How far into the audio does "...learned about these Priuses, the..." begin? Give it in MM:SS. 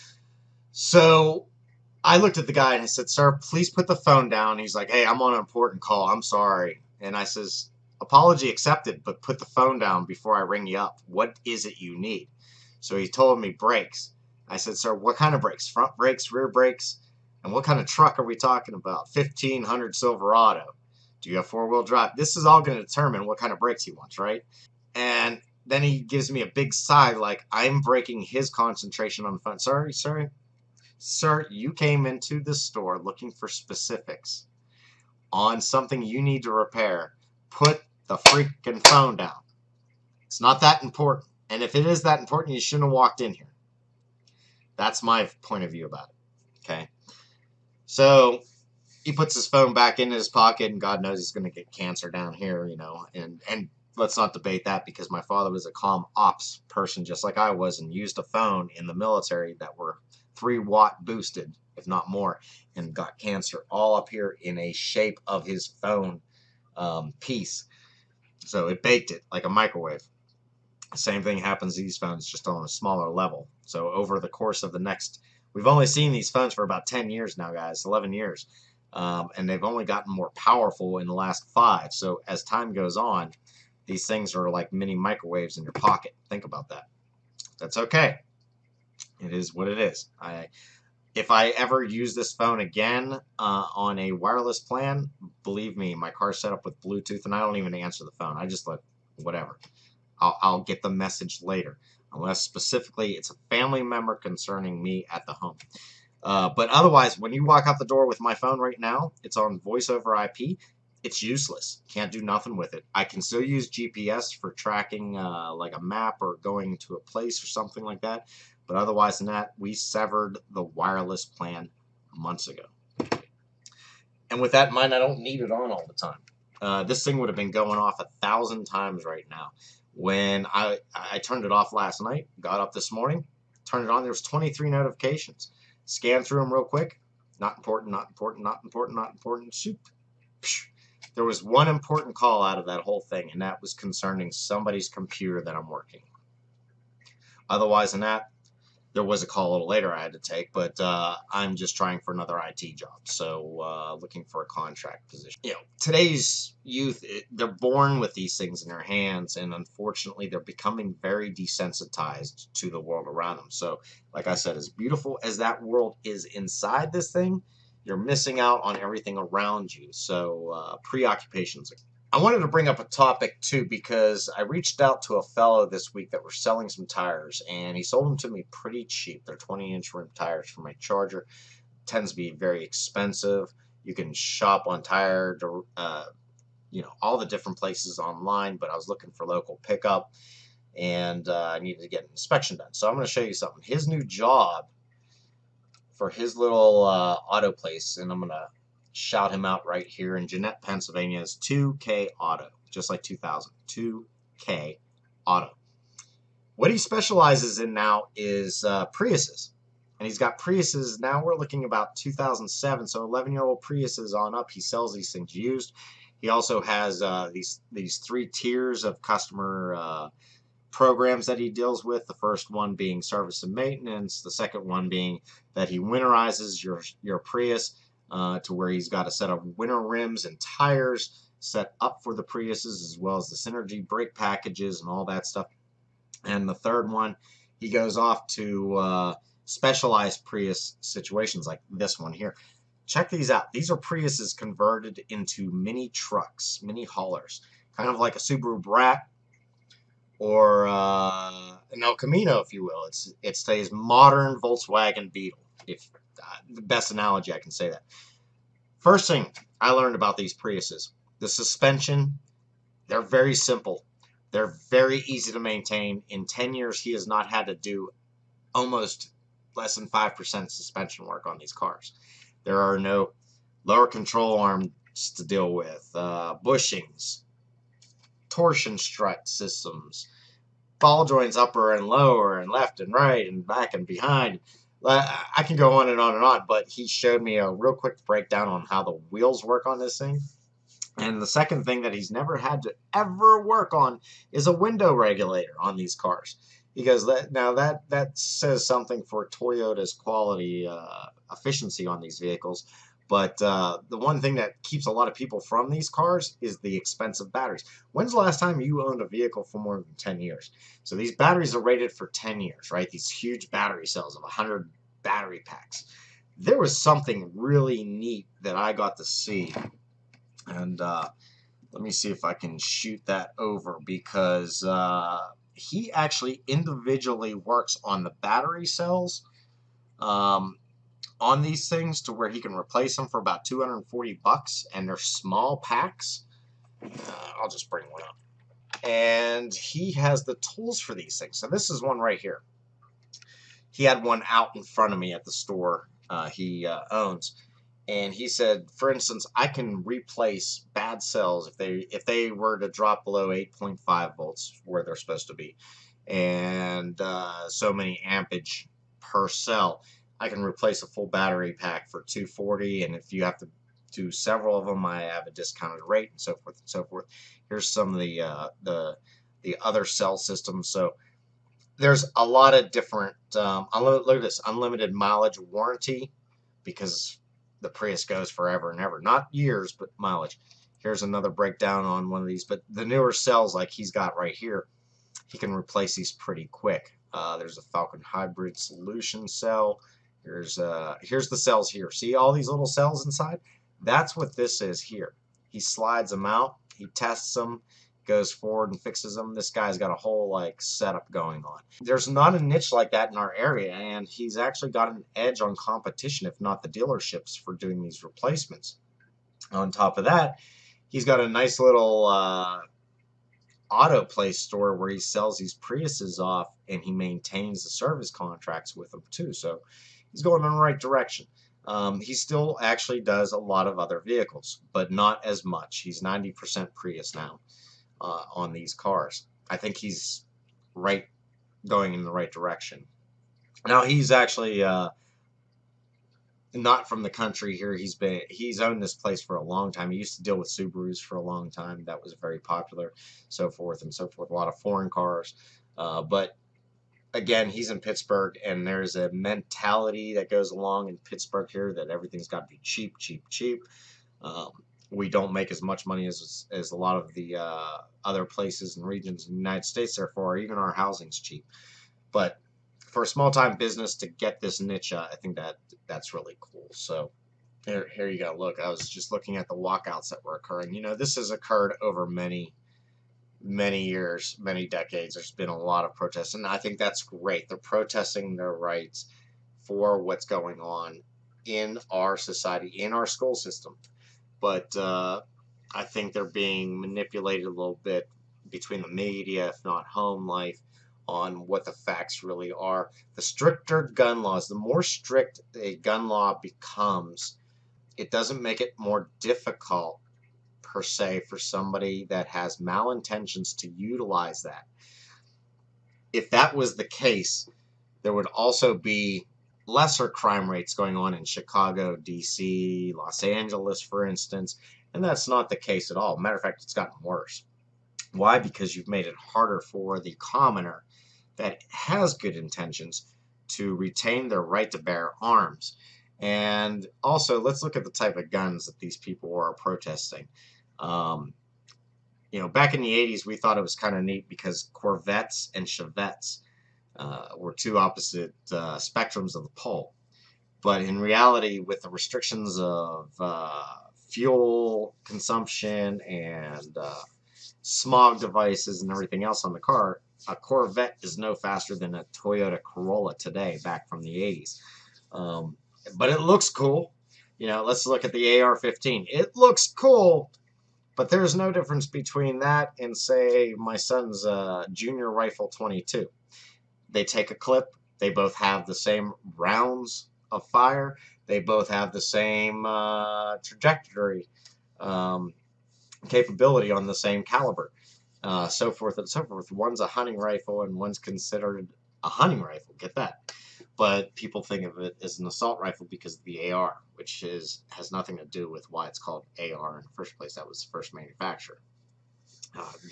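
04:19.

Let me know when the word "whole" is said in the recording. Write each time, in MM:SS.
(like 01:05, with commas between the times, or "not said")
02:22, 06:39.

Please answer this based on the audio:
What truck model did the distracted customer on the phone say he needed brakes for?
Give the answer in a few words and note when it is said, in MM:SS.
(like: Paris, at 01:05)
1500 Silverado, at 00:19.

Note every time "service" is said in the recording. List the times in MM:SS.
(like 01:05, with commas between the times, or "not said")
03:43, 06:57.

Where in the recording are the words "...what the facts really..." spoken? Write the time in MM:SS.
08:11.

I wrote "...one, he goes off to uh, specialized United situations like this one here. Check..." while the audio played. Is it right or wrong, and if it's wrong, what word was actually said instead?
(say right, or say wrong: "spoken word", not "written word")
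wrong: "Prius", not "United".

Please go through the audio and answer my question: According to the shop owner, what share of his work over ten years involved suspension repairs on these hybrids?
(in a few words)
less than 5%.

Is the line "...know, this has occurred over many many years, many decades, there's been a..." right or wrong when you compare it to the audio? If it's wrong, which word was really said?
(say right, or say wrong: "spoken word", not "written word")
right.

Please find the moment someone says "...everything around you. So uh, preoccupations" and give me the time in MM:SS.
02:48.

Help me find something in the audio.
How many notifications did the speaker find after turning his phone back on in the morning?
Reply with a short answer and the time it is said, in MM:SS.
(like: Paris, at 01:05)
23, at 02:14.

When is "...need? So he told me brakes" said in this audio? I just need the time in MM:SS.
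00:11.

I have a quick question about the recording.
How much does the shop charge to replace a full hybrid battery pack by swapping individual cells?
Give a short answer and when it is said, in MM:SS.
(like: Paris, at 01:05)
$240, at 05:33.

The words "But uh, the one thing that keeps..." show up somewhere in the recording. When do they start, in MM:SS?
05:03.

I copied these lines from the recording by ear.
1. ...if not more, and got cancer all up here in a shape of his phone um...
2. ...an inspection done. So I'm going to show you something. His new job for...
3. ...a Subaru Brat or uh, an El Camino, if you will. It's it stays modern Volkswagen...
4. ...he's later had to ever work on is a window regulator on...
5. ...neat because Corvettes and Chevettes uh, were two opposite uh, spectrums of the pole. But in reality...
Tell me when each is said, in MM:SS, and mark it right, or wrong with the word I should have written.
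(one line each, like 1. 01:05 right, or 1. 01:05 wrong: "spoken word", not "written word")
1. 01:01 right
2. 03:12 right
3. 04:08 right
4. 04:51 wrong: "never", not "later"
5. 08:54 right.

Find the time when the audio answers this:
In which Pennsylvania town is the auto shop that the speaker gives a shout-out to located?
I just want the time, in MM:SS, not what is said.
03:20.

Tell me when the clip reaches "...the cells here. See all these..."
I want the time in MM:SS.
06:31.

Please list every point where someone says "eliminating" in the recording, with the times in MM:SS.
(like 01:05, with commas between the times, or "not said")
not said.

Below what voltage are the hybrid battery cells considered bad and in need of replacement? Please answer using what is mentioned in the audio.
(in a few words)
8.5 volts.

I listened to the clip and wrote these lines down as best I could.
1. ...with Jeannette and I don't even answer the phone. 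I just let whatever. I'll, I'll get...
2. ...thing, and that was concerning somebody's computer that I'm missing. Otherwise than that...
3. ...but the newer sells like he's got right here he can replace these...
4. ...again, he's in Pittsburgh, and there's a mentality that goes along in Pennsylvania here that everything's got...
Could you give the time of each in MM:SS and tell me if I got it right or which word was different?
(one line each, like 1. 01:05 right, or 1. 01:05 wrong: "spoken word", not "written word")
1. 01:36 wrong: "Bluetooth", not "Jeannette"
2. 02:23 wrong: "working", not "missing"
3. 06:22 wrong: "cells", not "sells"
4. 07:27 wrong: "Pittsburgh", not "Pennsylvania".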